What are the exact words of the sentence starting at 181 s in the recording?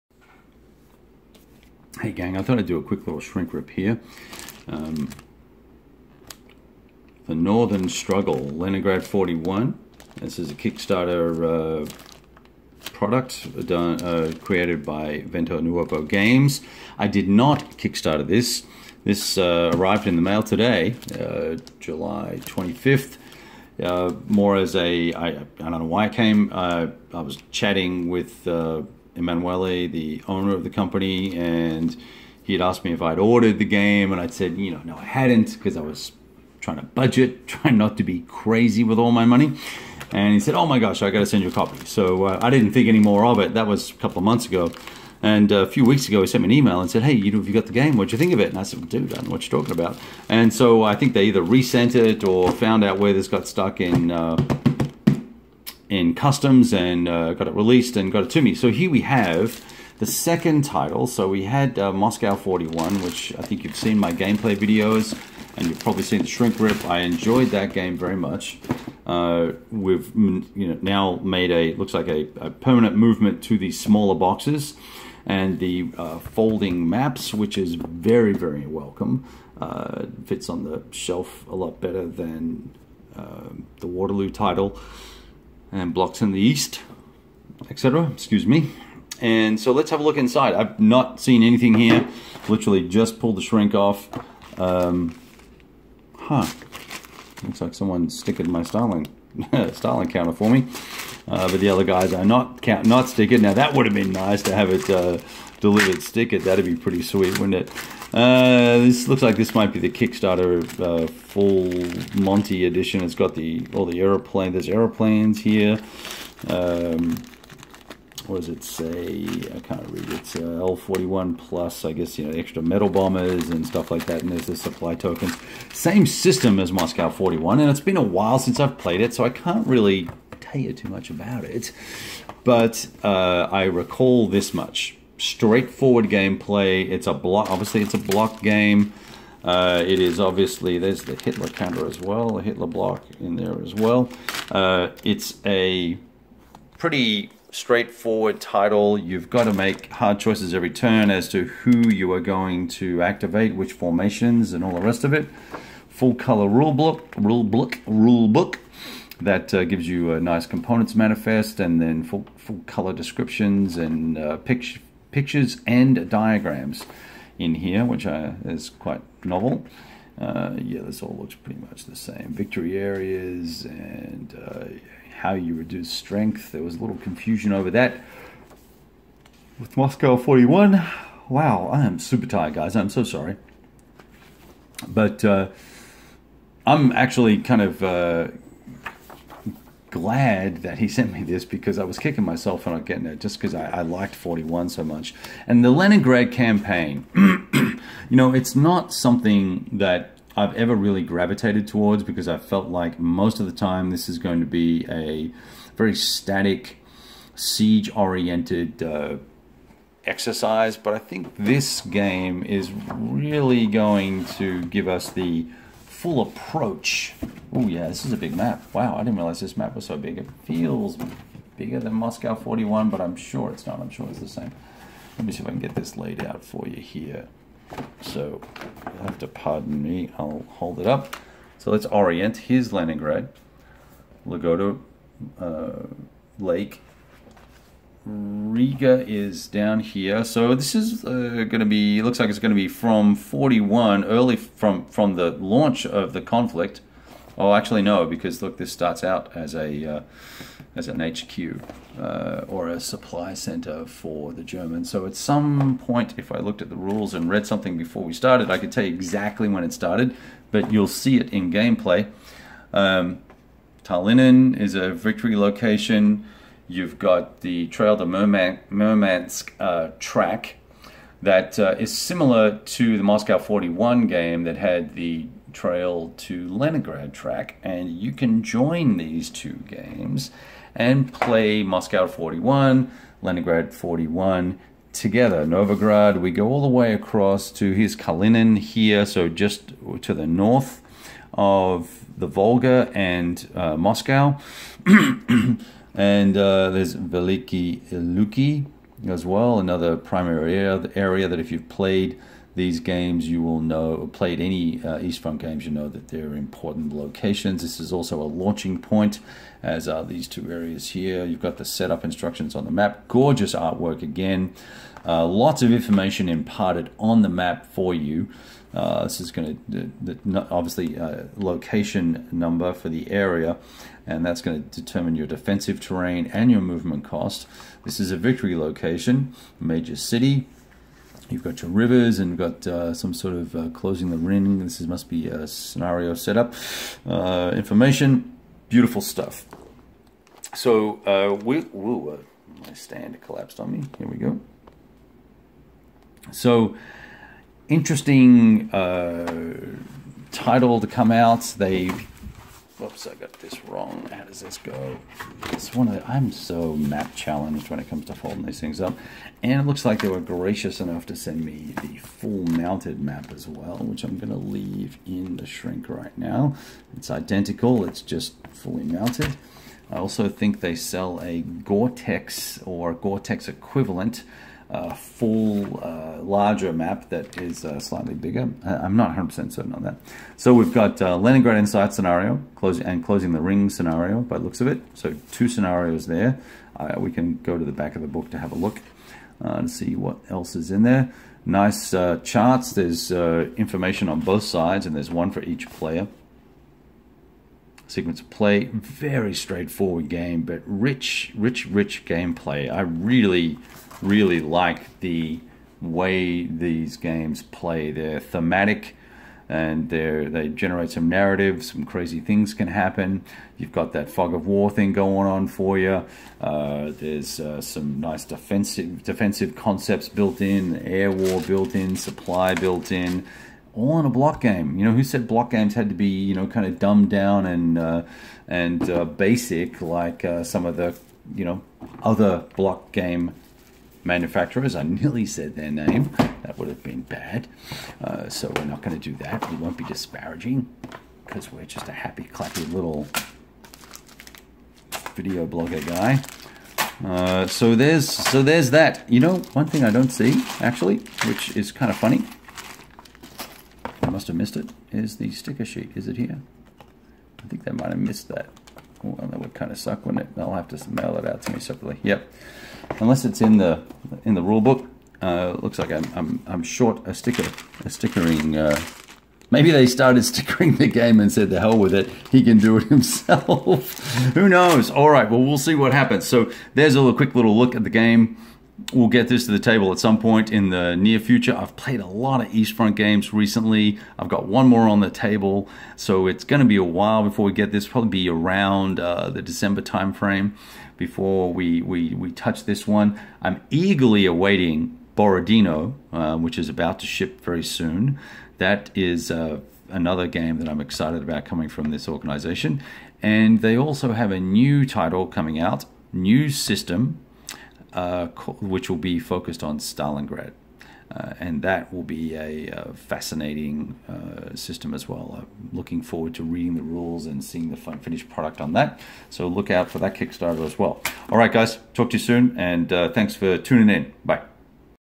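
Wow, I am super tired, guys.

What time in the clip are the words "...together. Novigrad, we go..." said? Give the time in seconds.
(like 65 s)
284 s.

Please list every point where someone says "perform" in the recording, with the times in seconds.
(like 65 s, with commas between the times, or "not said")
not said.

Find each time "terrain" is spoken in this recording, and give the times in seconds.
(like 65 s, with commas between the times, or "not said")
325 s.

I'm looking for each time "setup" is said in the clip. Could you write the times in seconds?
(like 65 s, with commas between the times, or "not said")
311 s, 336 s.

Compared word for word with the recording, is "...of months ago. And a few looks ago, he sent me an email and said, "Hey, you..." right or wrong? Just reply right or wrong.
wrong.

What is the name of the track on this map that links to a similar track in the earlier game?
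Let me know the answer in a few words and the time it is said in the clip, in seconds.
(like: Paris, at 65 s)
Trail to Murmansk, at 267 s.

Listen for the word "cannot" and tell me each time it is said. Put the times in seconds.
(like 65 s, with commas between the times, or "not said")
not said.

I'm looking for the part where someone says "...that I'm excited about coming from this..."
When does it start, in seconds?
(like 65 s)
500 s.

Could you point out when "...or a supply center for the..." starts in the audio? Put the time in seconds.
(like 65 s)
252 s.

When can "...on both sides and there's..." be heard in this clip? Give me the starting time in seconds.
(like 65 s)
394 s.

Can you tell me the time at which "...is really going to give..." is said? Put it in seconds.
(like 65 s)
212 s.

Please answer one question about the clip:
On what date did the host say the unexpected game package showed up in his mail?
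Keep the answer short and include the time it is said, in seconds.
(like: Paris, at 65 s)
July 25th, at 21 s.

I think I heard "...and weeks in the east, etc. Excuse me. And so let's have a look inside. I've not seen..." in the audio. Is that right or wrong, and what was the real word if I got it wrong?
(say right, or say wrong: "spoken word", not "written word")
wrong: "blocks", not "weeks".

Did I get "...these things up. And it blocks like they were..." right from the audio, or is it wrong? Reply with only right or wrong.
wrong.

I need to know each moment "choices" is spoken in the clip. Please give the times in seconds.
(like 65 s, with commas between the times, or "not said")
150 s.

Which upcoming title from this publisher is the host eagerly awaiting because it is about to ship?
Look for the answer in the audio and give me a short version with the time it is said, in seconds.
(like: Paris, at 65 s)
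Borodino, at 495 s.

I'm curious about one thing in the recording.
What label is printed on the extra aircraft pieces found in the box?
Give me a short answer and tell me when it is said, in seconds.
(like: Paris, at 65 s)
L41 plus, at 120 s.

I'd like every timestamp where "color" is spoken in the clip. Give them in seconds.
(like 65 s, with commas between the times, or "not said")
156 s, 162 s.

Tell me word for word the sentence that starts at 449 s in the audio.
You know, one thing I don't see actually, which is kind of funny.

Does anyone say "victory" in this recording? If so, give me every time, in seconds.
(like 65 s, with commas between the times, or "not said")
172 s, 264 s, 328 s.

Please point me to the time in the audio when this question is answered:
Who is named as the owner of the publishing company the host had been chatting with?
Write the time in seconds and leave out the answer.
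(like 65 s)
29 s.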